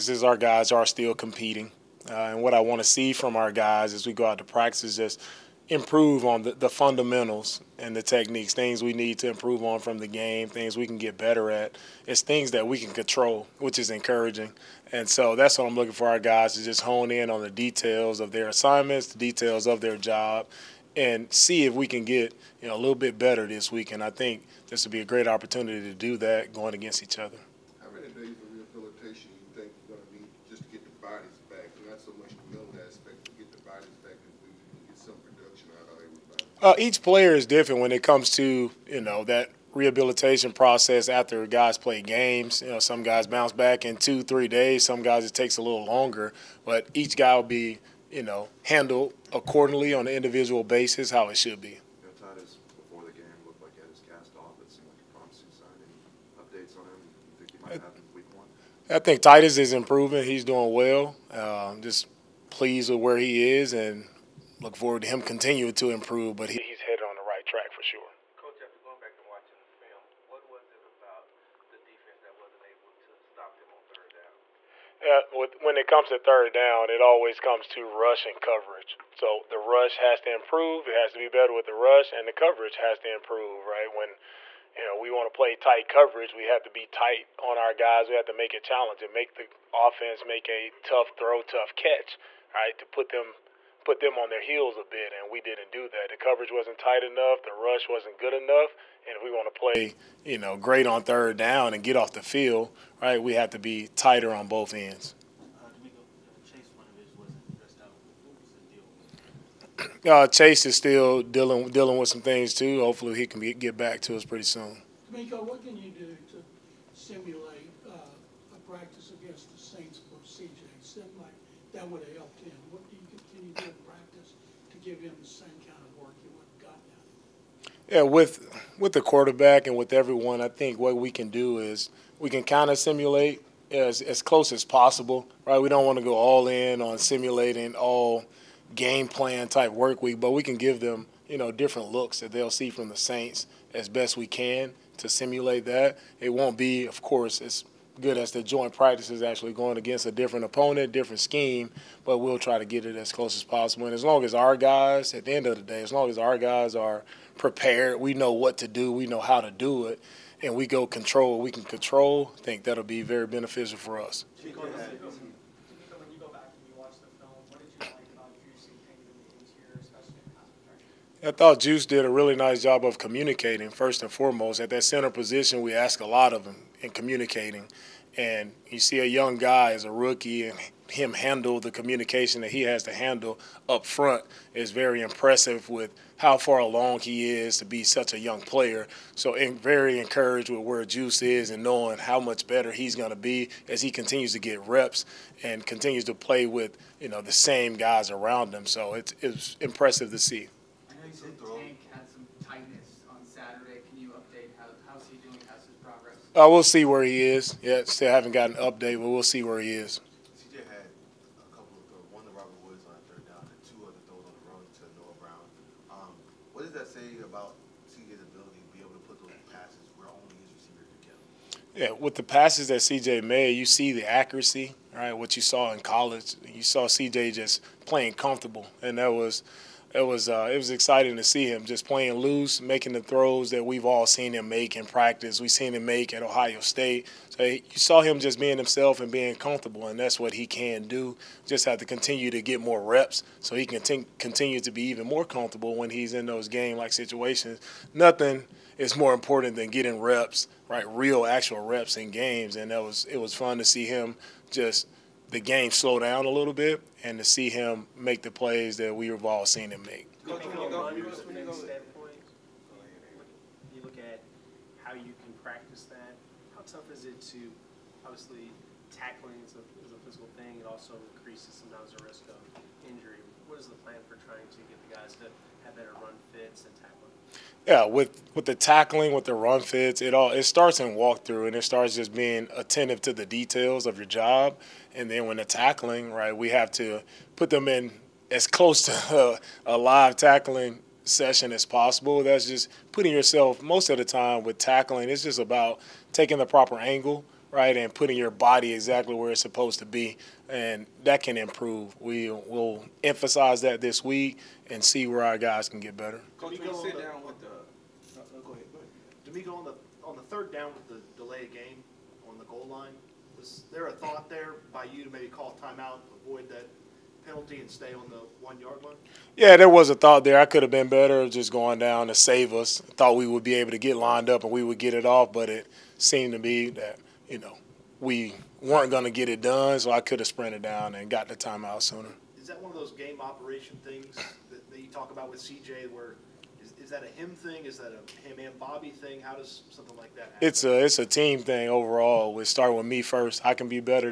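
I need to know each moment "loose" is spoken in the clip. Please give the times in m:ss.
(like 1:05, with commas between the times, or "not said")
3:52.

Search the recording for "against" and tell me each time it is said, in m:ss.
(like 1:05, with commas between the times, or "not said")
0:26, 1:59, 2:29.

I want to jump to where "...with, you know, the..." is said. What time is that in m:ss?
3:16.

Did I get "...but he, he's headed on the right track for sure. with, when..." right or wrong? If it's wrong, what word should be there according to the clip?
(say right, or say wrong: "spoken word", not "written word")
right.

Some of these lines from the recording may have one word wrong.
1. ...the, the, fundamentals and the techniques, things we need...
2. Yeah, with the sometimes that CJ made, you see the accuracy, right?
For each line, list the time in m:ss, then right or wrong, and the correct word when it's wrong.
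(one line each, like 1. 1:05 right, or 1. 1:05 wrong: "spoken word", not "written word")
1. 0:06 right
2. 3:41 wrong: "passes", not "sometimes".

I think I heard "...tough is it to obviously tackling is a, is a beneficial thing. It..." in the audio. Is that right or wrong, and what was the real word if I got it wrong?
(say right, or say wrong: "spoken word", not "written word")
wrong: "physical", not "beneficial".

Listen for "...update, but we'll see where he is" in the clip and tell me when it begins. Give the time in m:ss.
3:28.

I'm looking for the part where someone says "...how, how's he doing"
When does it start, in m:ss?
3:24.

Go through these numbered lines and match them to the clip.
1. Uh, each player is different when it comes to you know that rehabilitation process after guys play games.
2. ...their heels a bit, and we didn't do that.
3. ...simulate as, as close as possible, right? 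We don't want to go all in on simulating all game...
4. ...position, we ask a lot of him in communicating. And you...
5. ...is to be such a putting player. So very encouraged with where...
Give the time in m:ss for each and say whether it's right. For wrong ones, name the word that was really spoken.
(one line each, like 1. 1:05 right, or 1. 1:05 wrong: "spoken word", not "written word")
1. 0:36 right
2. 1:34 right
3. 2:12 right
4. 2:55 right
5. 3:07 wrong: "young", not "putting".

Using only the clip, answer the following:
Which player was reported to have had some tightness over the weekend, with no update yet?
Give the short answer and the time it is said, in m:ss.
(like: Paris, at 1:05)
Tank, at 3:21.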